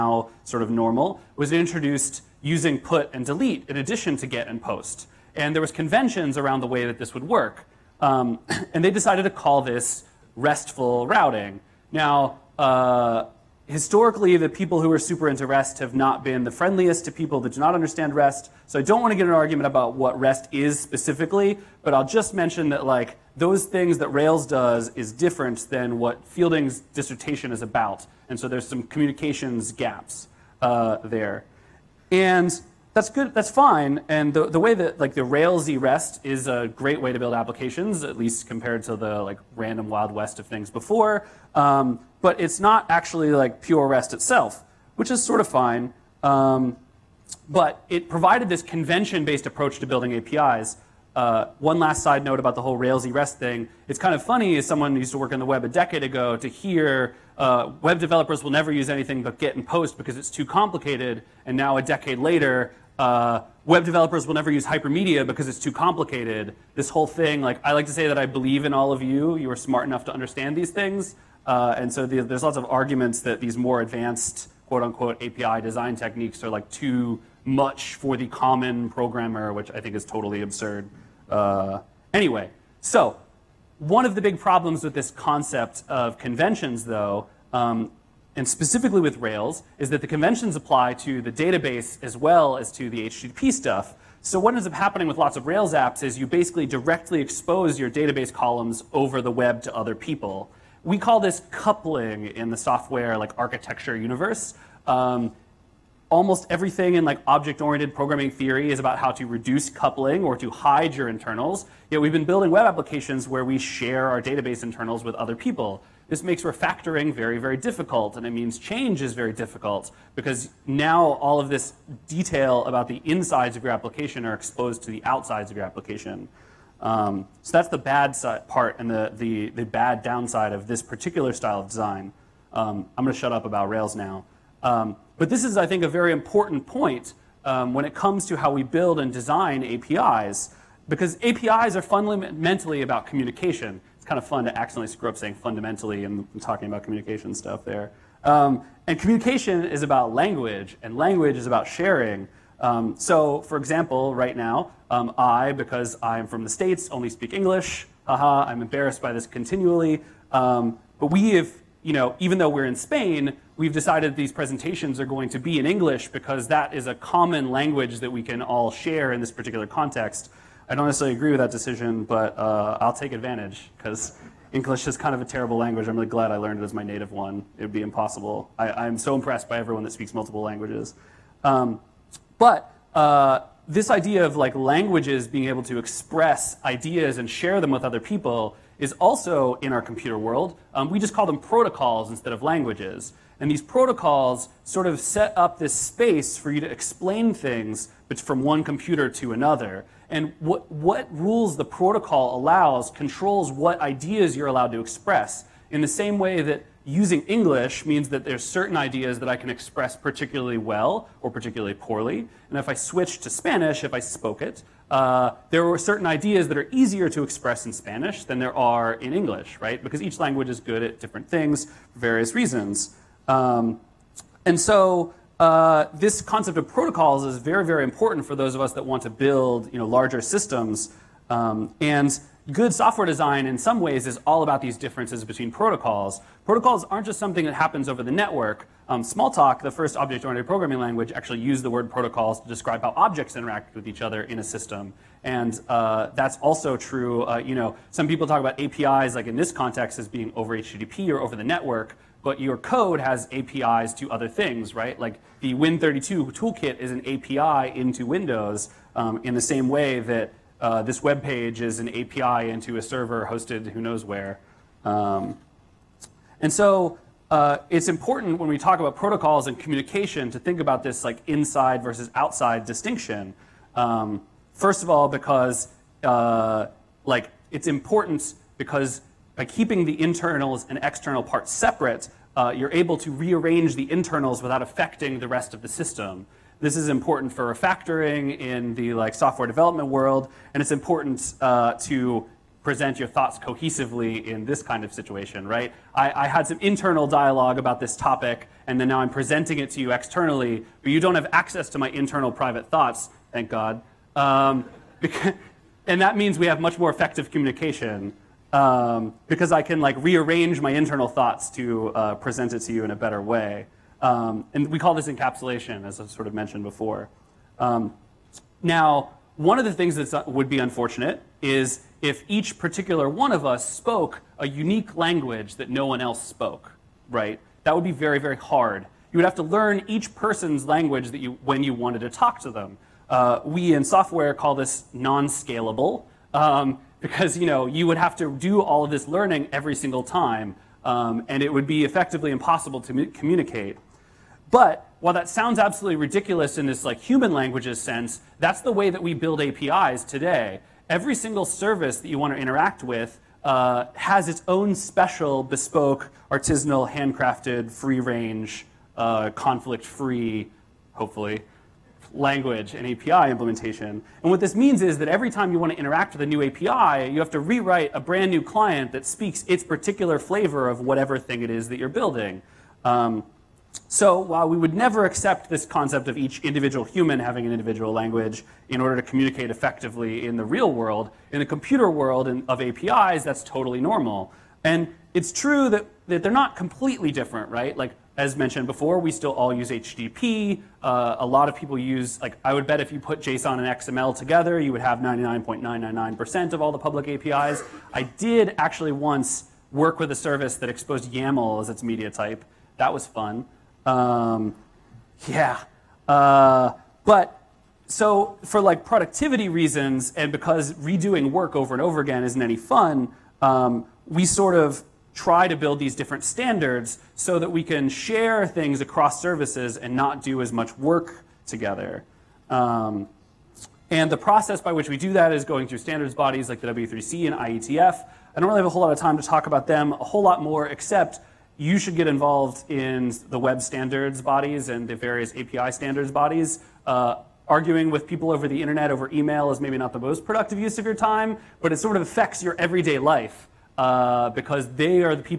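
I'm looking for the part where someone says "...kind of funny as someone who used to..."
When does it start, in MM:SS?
00:53.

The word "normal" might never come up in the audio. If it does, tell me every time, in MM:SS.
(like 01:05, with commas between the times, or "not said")
00:00, 06:23.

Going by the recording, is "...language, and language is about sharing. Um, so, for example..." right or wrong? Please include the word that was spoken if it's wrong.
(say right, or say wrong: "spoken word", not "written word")
right.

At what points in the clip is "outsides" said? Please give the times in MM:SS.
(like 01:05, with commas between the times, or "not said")
02:05, 04:32.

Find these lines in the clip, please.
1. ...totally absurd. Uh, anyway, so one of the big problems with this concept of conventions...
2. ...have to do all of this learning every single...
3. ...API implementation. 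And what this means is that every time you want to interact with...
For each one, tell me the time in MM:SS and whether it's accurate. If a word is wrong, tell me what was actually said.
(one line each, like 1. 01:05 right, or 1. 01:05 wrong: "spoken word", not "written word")
1. 01:20 right
2. 05:37 right
3. 06:02 right.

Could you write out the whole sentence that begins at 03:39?
Because each language is good at different things for various reasons.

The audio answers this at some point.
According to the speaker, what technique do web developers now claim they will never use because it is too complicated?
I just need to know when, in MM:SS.
01:04.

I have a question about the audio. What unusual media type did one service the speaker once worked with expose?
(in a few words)
YAML.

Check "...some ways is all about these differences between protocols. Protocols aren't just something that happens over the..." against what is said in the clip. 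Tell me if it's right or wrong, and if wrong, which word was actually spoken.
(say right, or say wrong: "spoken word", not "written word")
right.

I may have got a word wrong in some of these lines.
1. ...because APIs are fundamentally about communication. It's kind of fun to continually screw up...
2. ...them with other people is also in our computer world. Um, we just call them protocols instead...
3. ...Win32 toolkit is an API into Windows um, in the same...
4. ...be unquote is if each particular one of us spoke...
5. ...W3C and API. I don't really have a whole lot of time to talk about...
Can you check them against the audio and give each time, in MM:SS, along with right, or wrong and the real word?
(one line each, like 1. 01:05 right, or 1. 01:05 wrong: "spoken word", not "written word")
1. 02:20 wrong: "accidentally", not "continually"
2. 03:07 right
3. 04:15 right
4. 05:20 wrong: "unfortunate", not "unquote"
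5. 07:06 wrong: "IETF", not "API".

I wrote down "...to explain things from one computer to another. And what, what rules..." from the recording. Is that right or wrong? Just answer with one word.
right.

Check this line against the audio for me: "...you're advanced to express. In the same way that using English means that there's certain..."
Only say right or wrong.
wrong.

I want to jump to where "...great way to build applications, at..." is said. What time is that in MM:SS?
00:36.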